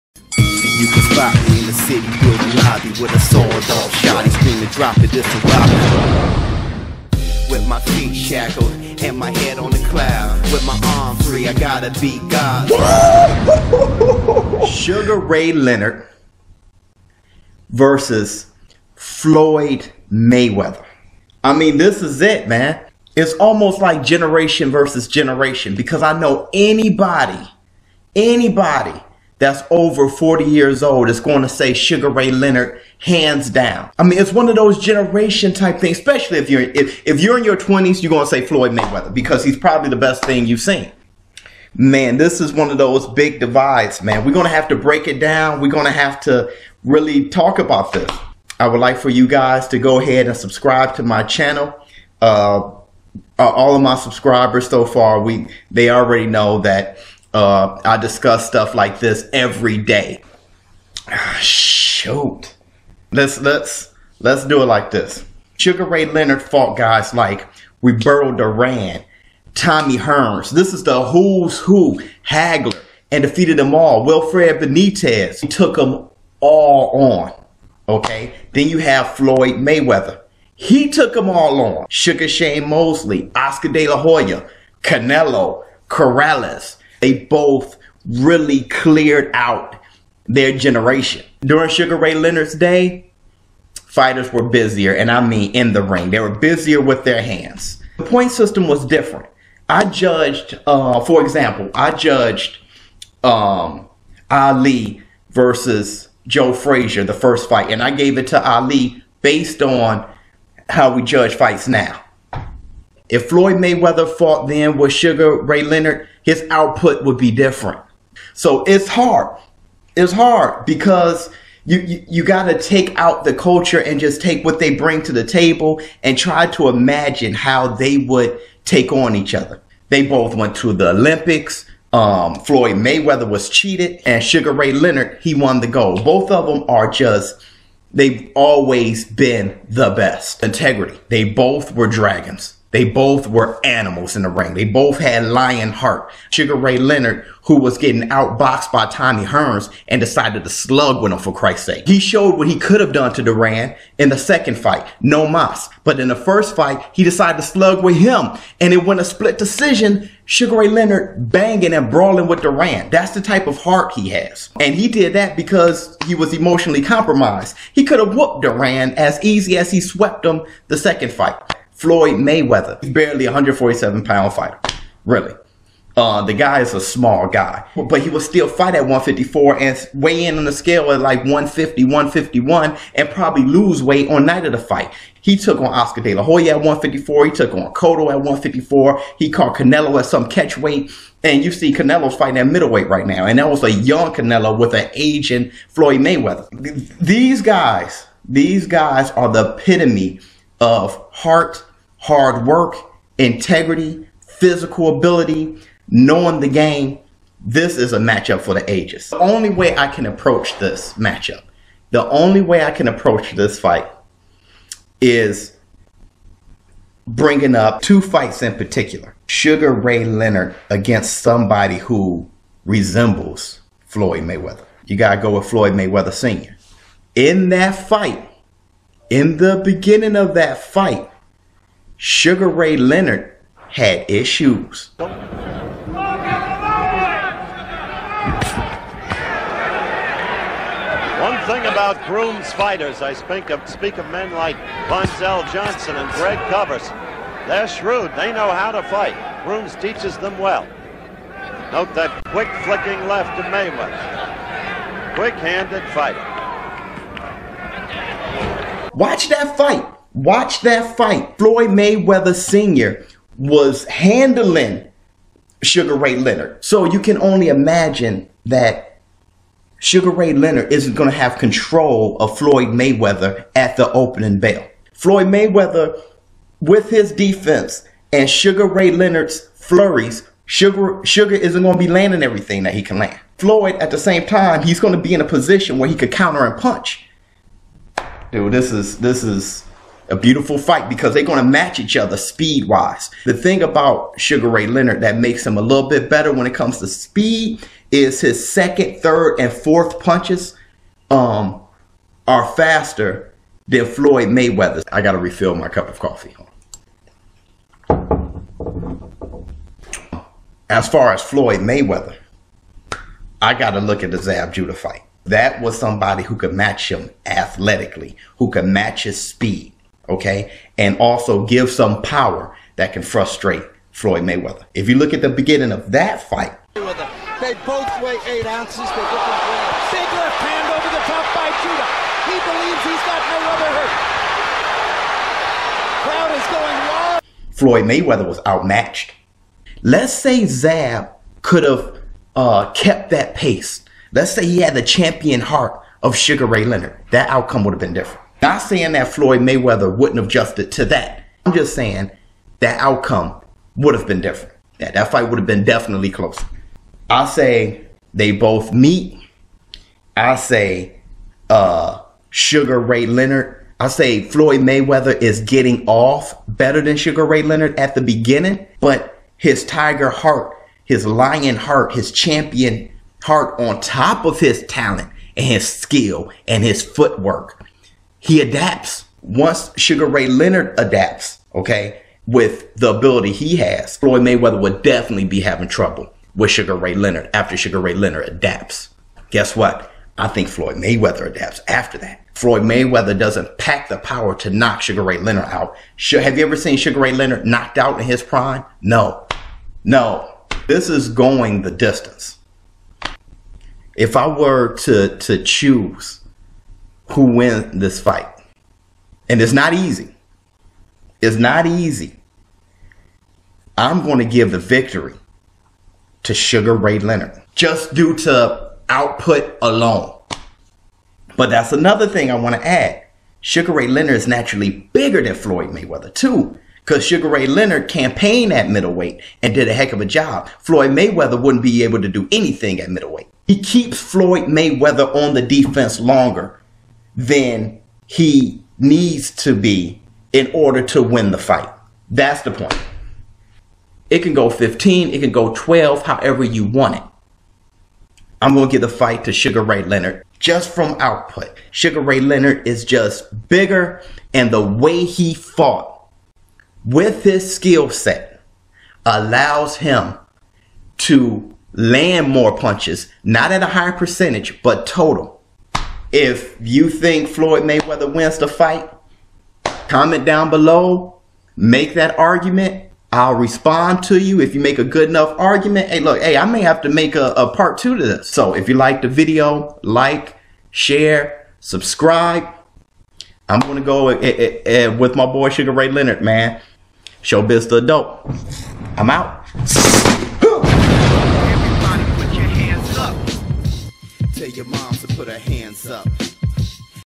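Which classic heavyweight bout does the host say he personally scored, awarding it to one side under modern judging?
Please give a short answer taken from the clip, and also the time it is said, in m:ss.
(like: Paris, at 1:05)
Ali versus Joe Frazier, at 1:44.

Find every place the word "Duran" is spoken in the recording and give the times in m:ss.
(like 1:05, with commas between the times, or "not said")
1:08, 2:33, 2:42, 2:48.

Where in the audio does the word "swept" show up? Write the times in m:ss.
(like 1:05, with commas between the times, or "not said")
2:49.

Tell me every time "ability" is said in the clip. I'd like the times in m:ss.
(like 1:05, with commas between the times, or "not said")
3:24, 6:22.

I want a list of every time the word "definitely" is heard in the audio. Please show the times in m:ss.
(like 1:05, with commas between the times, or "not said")
5:55, 6:24.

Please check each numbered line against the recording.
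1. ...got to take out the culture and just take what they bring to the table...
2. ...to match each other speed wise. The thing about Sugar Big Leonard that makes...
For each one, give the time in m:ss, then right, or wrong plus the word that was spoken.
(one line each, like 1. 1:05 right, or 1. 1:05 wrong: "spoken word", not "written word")
1. 2:02 right
2. 4:51 wrong: "Ray", not "Big".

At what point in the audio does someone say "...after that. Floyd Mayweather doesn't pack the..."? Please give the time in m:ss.
6:31.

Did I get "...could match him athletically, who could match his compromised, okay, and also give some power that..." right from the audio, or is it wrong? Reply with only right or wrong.
wrong.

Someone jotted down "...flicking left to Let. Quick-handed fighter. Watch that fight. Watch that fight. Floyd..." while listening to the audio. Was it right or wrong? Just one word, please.
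wrong.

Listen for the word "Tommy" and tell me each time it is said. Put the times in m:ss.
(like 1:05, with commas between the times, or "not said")
1:09, 2:28.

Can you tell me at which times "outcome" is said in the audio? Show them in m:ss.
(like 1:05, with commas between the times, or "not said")
5:47, 5:52.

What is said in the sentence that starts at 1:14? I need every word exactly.
Wilfred Benitez took them all on.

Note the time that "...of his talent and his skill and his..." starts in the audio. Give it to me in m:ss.
6:14.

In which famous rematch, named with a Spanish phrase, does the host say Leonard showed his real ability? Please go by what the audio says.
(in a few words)
No mas.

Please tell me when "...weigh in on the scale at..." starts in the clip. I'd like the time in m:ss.
2:59.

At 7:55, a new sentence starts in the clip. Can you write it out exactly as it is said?
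Hey, look, hey, I may have to make a, a part two to this.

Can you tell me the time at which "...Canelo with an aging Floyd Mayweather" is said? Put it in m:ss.
3:14.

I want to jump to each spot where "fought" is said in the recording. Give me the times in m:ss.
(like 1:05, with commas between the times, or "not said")
1:06, 1:54, 7:35.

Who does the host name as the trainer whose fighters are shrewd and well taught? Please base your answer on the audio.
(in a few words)
Grooms.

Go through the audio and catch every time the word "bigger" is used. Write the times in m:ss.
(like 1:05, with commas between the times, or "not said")
7:04, 7:33.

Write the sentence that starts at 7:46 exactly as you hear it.
If you think Floyd Mayweather wins the fight, comment down below, make that argument.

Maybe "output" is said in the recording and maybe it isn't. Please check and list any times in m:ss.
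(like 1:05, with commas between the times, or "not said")
1:56, 6:58, 7:30.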